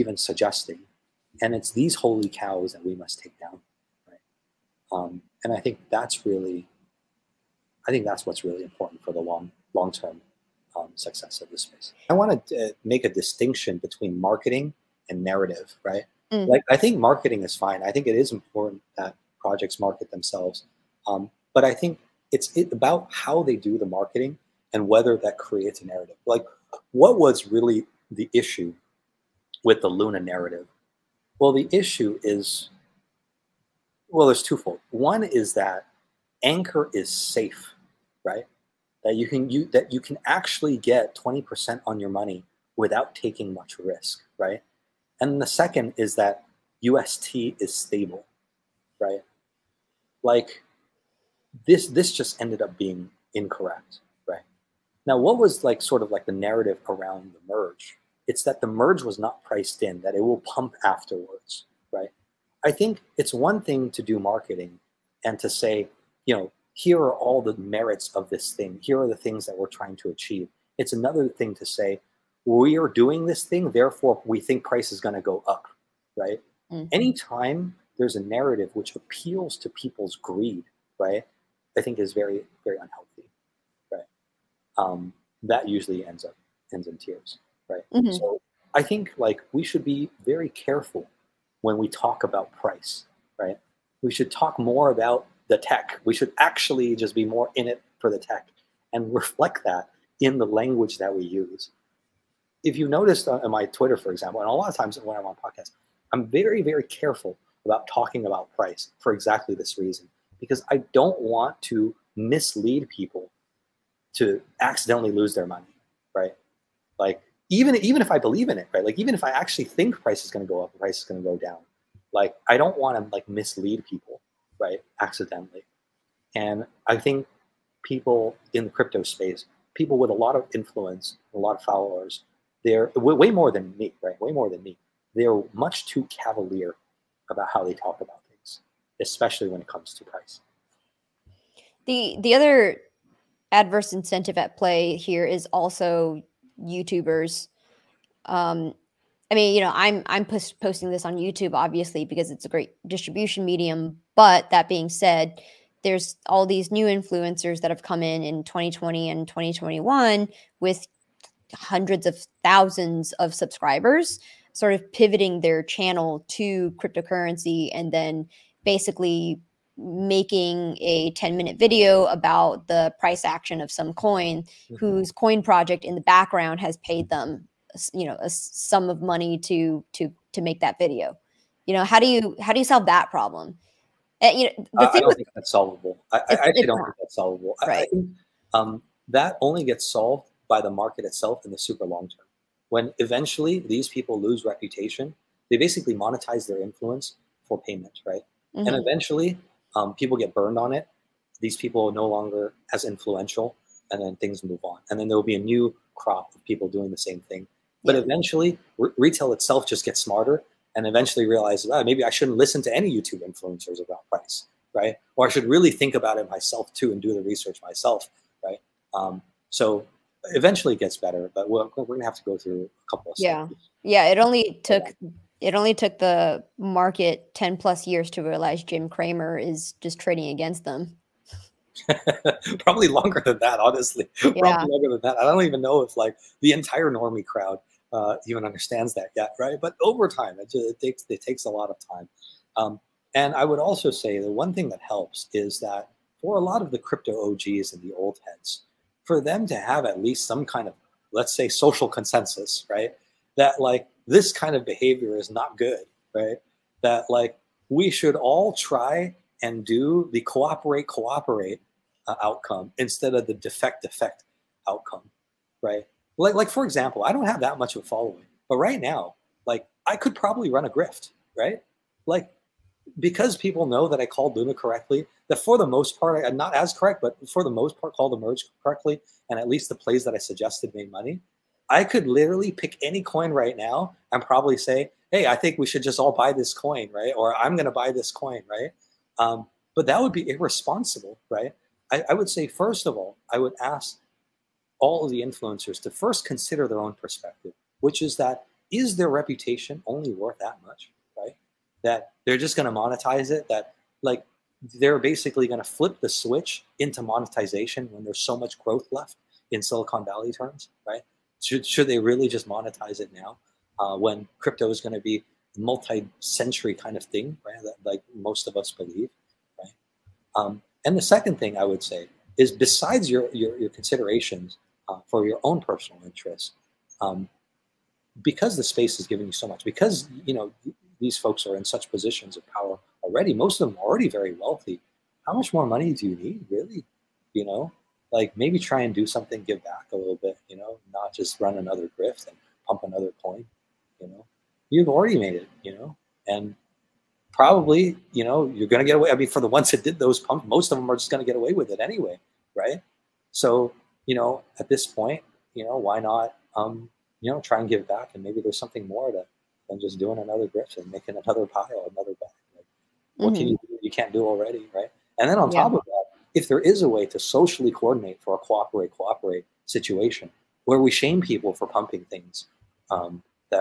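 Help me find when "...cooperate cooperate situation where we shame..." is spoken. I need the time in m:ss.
6:08.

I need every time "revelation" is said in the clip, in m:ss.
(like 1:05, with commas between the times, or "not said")
not said.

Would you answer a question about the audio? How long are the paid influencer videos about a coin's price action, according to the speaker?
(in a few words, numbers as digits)
10 minutes.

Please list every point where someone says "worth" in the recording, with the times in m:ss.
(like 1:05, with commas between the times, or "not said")
5:00.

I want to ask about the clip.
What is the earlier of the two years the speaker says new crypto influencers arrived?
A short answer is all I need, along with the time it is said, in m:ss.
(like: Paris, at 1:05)
2020, at 2:38.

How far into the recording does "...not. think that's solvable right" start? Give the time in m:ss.
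3:06.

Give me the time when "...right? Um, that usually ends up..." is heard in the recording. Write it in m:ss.
1:23.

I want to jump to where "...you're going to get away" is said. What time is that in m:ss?
5:48.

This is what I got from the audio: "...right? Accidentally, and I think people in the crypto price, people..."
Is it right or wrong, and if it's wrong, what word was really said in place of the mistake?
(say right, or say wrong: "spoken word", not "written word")
wrong: "space", not "price".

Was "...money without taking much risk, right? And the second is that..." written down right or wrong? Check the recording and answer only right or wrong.
right.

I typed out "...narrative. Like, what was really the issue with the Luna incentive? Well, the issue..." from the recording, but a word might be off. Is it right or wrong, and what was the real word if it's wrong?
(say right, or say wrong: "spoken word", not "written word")
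wrong: "narrative", not "incentive".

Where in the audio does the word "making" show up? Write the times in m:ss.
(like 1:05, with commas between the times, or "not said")
2:49, 6:00.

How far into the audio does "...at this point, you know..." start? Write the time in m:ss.
5:54.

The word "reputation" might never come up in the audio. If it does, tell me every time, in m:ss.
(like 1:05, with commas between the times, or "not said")
3:14, 4:59.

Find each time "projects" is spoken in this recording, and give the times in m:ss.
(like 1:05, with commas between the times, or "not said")
0:19, 2:55.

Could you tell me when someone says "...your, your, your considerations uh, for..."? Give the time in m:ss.
5:23.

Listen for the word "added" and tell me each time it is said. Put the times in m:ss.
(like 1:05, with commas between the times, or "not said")
not said.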